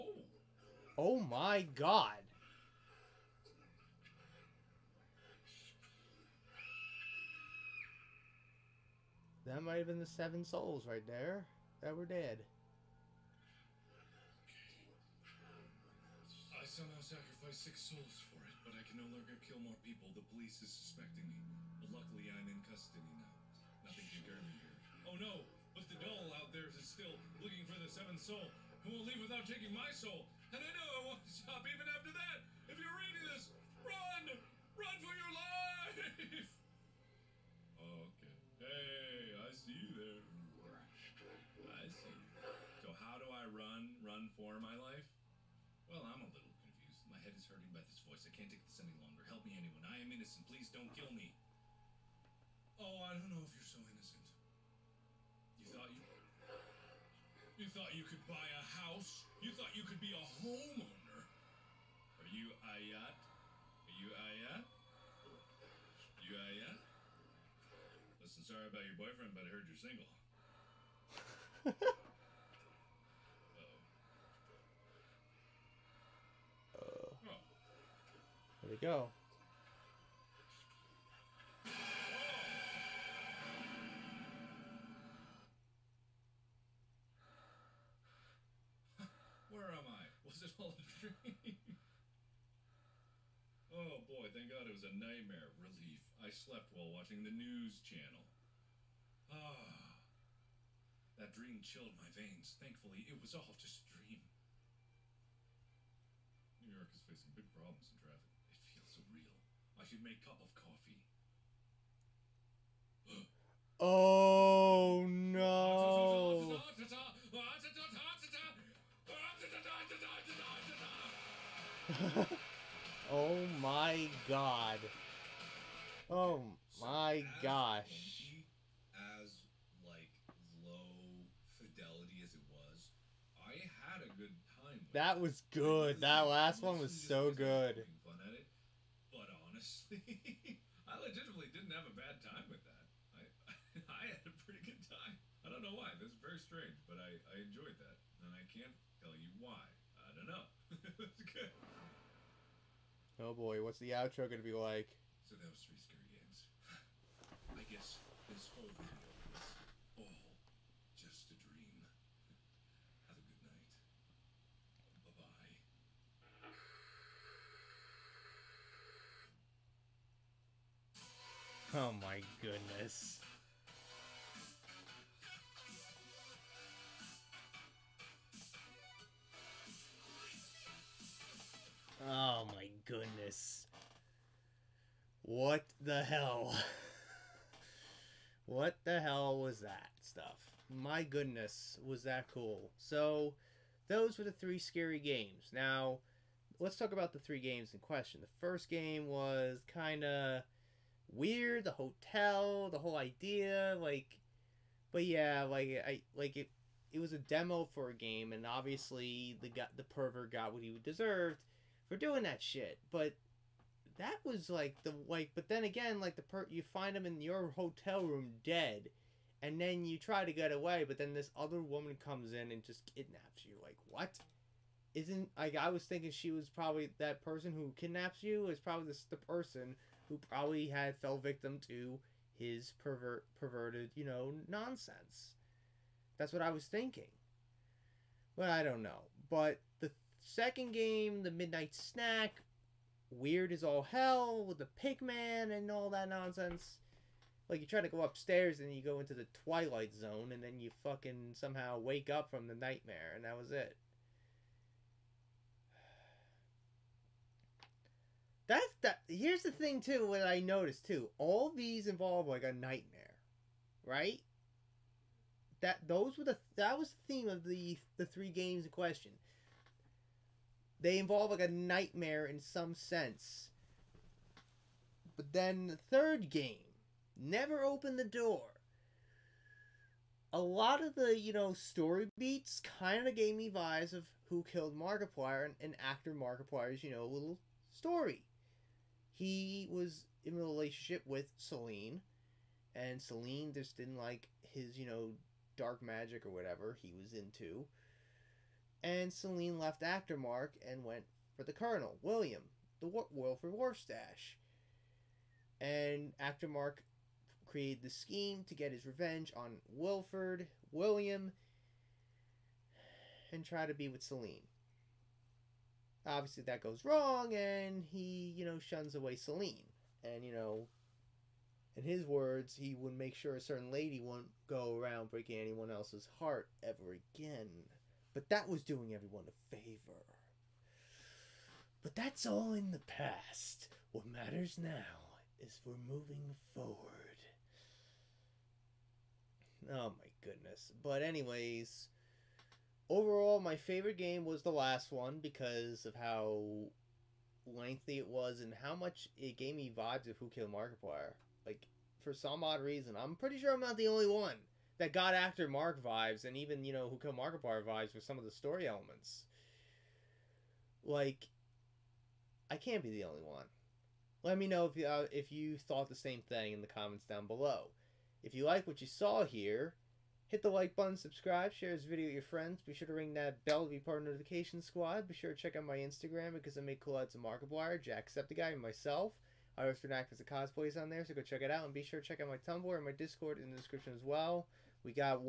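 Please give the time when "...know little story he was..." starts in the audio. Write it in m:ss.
4:46.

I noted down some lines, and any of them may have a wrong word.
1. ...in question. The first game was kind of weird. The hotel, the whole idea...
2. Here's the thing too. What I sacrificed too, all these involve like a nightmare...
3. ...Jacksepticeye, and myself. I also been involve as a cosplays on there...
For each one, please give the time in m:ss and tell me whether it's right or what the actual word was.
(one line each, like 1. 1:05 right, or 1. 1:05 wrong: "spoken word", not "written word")
1. 3:17 right
2. 4:19 wrong: "noticed", not "sacrificed"
3. 6:17 wrong: "active", not "involve".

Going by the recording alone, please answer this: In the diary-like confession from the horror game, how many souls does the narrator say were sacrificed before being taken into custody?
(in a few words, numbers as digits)
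6.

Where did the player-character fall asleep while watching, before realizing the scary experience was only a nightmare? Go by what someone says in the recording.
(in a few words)
news channel.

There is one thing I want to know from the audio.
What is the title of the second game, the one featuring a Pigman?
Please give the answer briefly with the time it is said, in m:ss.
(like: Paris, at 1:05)
Midnight Snack, at 4:01.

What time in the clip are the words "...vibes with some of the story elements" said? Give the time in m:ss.
5:57.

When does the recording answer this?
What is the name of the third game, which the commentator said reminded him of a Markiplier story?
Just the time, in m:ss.
4:37.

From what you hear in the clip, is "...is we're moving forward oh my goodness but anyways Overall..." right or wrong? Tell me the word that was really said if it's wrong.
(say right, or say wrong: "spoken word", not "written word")
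right.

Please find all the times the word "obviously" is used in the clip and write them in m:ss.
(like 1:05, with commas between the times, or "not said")
3:28, 5:16.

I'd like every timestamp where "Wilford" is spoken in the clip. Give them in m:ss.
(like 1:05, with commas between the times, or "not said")
5:03, 5:09.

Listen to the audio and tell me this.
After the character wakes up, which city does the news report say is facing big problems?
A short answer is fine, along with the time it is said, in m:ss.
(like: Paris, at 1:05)
New York, at 1:46.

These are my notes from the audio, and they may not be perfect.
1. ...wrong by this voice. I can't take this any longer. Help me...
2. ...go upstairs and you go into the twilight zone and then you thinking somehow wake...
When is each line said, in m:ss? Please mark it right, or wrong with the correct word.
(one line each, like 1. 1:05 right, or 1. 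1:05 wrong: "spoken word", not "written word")
1. 0:47 wrong: "hurting", not "wrong"
2. 4:07 wrong: "fucking", not "thinking".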